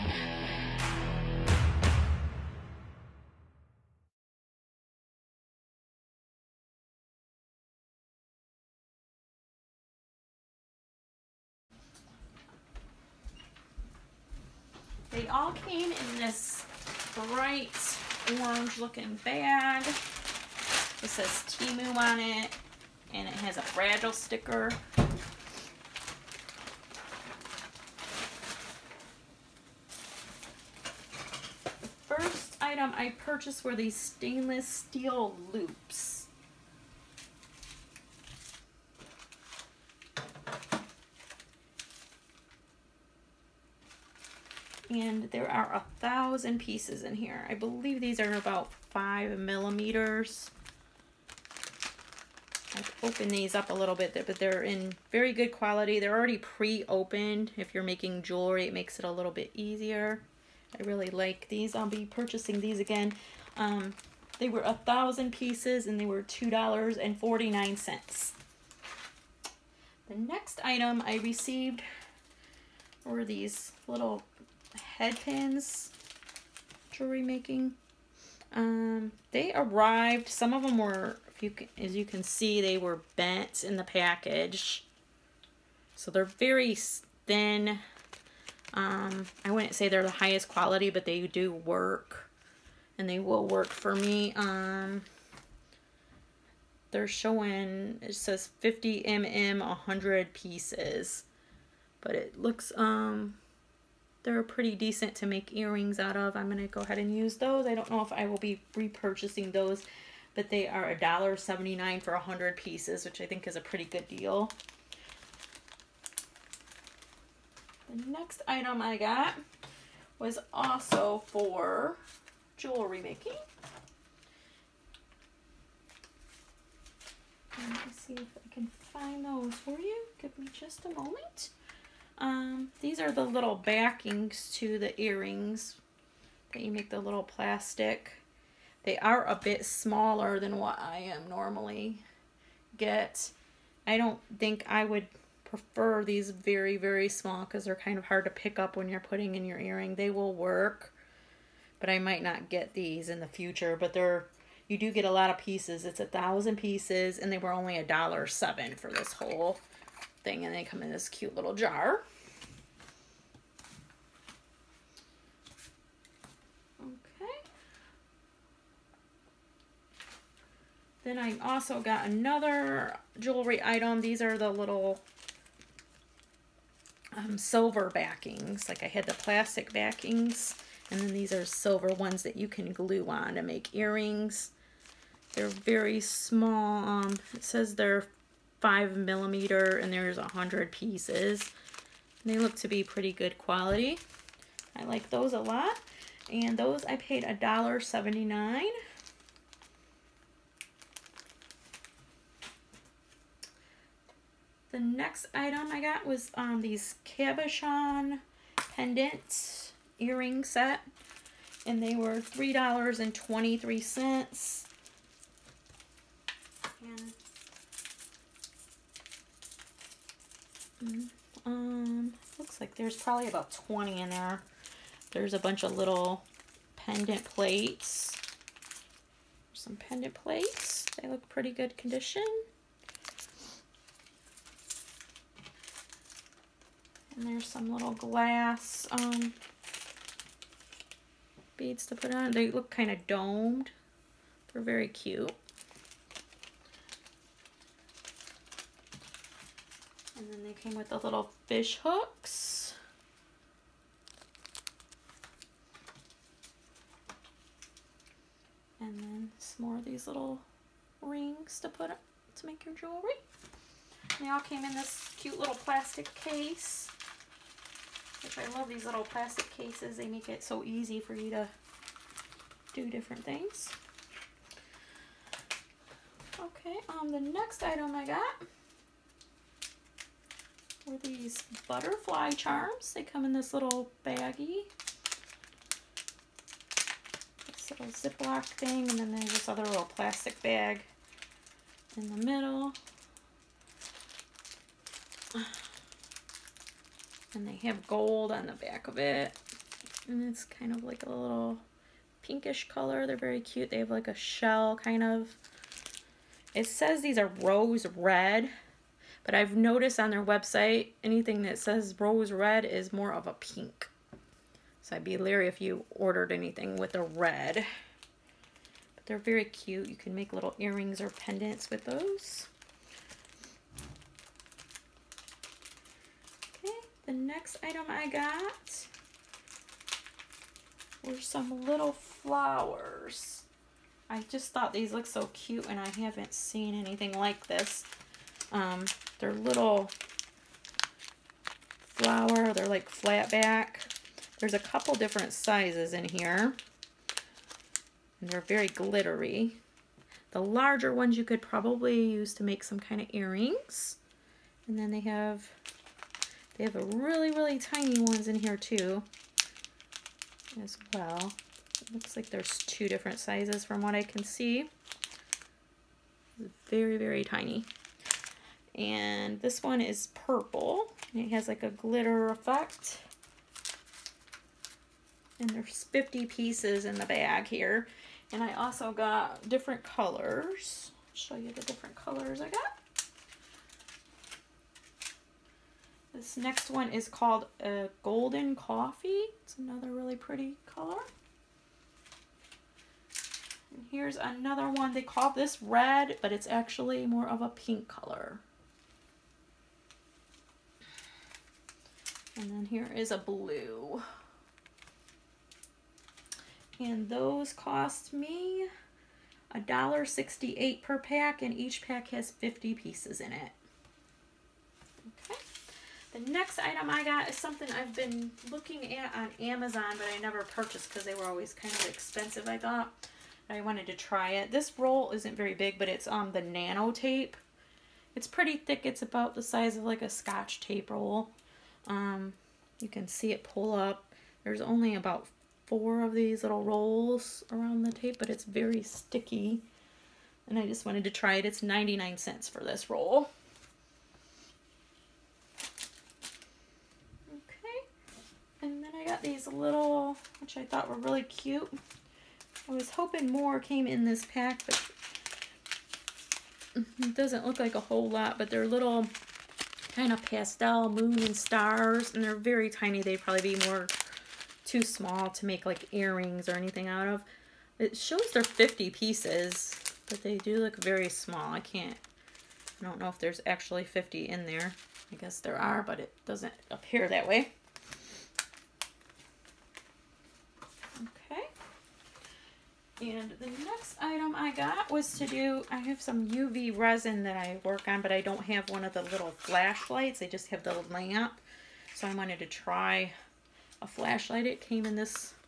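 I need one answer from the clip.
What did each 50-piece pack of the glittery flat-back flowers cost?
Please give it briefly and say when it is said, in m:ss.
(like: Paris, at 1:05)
$1.68, at 6:49.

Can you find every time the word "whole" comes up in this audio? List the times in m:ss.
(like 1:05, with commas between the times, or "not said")
2:39, 7:37.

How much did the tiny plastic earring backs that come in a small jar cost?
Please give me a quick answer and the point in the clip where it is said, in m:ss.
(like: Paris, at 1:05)
$1.07, at 2:37.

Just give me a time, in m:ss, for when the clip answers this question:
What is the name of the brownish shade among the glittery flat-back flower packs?
6:28.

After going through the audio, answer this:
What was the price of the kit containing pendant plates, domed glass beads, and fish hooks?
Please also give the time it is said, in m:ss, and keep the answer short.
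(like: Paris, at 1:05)
$3.23, at 3:32.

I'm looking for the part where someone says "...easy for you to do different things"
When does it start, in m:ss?
4:30.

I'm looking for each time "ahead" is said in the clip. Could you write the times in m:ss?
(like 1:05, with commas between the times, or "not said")
1:46.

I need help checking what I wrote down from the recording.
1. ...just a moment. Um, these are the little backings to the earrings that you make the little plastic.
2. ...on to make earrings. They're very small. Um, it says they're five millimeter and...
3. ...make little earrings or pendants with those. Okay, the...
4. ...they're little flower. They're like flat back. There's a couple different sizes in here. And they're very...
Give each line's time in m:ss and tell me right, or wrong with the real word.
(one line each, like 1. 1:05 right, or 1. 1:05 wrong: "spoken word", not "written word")
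1. 2:10 right
2. 3:03 right
3. 5:20 right
4. 5:39 right.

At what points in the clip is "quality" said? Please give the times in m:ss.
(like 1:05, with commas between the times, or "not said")
0:55, 1:30, 3:13.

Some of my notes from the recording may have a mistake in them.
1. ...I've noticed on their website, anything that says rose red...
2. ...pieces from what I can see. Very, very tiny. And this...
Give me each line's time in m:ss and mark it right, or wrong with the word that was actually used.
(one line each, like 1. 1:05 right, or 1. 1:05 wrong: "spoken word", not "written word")
1. 5:09 right
2. 6:03 wrong: "sizes", not "pieces".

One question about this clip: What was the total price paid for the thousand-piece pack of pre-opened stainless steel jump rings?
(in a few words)
$2.49.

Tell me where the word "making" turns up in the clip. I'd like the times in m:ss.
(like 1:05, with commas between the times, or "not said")
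0:57, 1:17, 2:03.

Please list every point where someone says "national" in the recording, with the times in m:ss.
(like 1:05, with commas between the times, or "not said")
not said.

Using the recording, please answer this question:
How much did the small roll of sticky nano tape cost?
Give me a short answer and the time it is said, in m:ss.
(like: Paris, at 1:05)
99 cents, at 7:21.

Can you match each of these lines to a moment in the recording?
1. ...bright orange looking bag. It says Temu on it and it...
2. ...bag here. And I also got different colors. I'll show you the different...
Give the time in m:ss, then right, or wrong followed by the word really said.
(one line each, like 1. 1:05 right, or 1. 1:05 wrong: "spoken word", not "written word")
1. 0:17 right
2. 6:17 right.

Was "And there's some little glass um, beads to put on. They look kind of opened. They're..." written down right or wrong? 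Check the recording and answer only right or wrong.
wrong.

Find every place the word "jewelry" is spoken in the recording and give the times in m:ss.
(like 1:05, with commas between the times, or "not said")
0:58, 1:16, 2:02, 2:53, 4:22.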